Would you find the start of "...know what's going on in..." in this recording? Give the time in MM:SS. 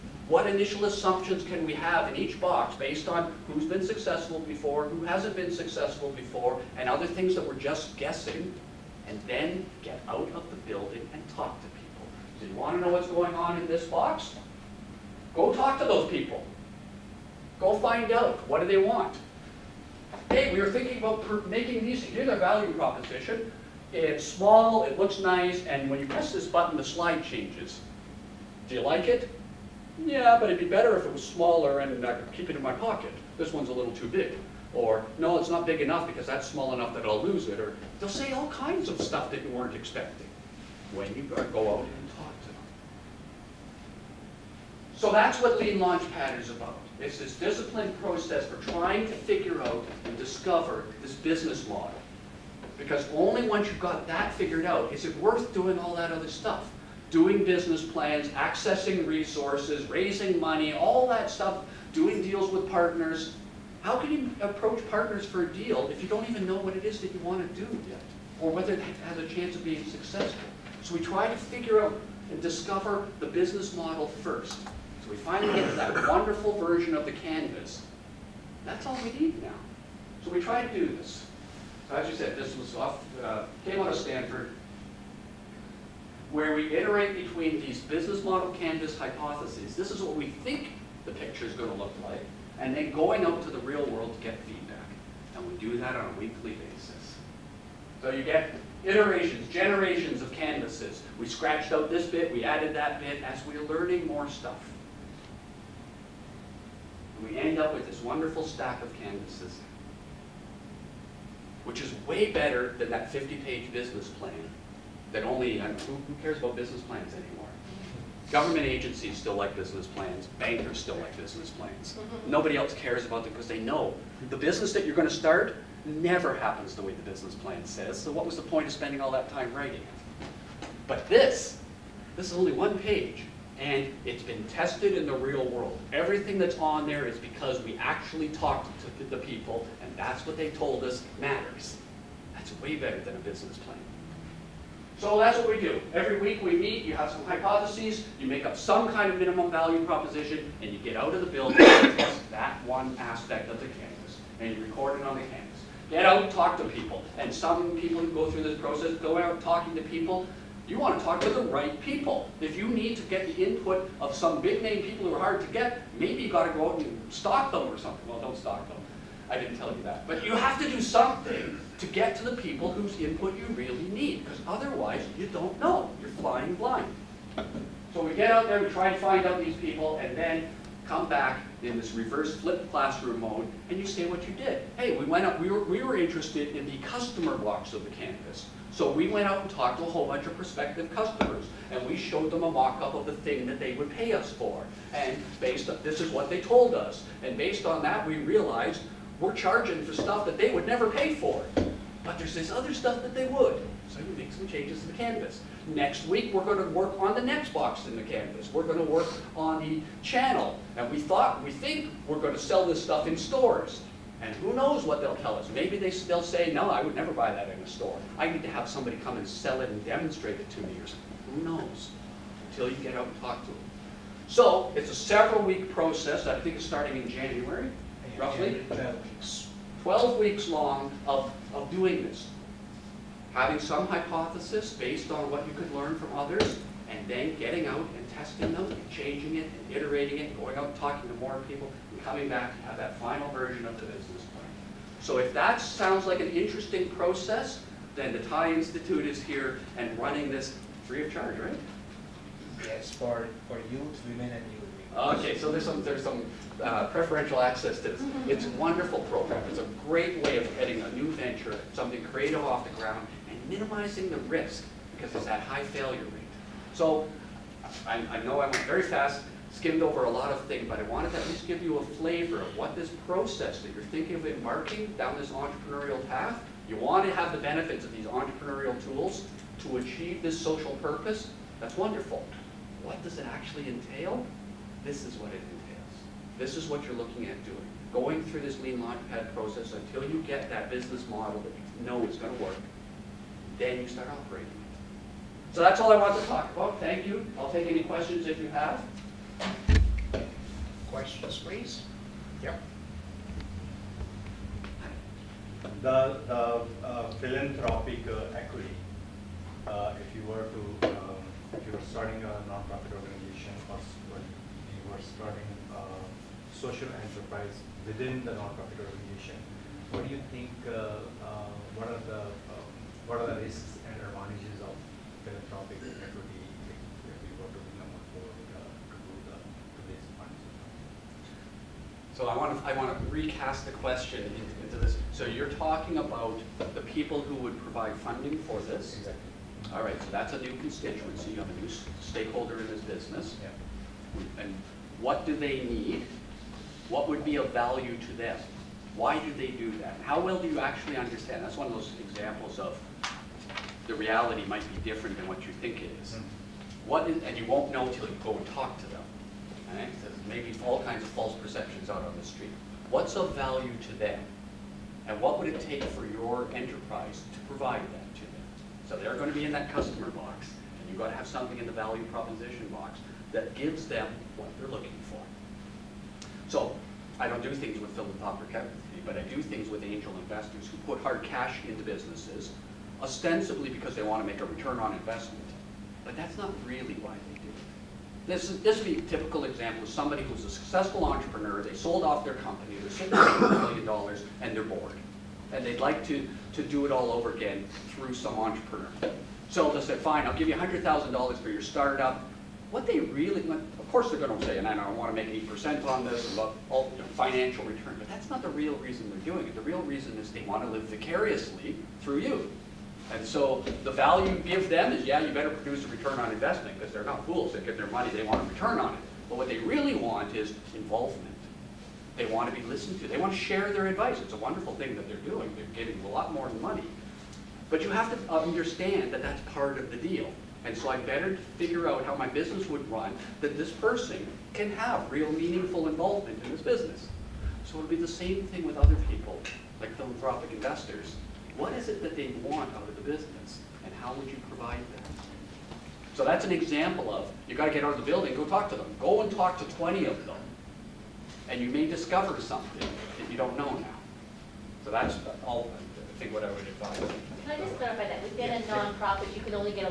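00:12.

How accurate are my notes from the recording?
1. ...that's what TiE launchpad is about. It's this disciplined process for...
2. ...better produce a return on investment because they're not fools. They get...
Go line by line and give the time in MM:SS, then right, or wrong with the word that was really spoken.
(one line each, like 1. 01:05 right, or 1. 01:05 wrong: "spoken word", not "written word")
1. 00:45 wrong: "Lean", not "TiE"
2. 06:55 right.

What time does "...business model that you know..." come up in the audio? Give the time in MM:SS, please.
04:50.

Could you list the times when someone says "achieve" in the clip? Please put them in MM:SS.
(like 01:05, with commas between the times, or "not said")
04:39.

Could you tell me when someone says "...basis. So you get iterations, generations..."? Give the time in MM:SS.
01:36.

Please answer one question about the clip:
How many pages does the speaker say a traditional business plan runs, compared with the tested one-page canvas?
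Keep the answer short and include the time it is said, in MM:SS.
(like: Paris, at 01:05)
50, at 01:53.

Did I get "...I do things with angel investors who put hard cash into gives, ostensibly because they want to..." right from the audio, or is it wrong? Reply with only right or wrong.
wrong.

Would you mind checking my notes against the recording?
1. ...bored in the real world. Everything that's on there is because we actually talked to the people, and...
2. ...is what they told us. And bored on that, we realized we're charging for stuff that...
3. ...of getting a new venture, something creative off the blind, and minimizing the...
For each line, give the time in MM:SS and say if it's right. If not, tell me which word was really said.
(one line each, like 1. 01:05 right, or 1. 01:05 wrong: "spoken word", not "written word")
1. 02:14 wrong: "tested", not "bored"
2. 03:16 wrong: "based", not "bored"
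3. 04:20 wrong: "ground", not "blind".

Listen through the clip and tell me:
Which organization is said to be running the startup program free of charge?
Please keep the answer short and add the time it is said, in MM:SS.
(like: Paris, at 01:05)
TiE Institute, at 04:08.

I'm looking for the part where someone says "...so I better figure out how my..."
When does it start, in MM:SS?
07:10.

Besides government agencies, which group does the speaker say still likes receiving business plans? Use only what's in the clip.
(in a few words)
Bankers.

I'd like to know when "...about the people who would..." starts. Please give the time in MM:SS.
05:35.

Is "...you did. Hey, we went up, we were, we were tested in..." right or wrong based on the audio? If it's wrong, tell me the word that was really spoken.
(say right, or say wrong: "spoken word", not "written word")
wrong: "interested", not "tested".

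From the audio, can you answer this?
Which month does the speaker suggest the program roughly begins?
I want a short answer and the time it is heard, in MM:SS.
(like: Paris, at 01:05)
January, at 03:47.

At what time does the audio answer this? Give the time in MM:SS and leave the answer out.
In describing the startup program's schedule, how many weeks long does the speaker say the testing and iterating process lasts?
03:49.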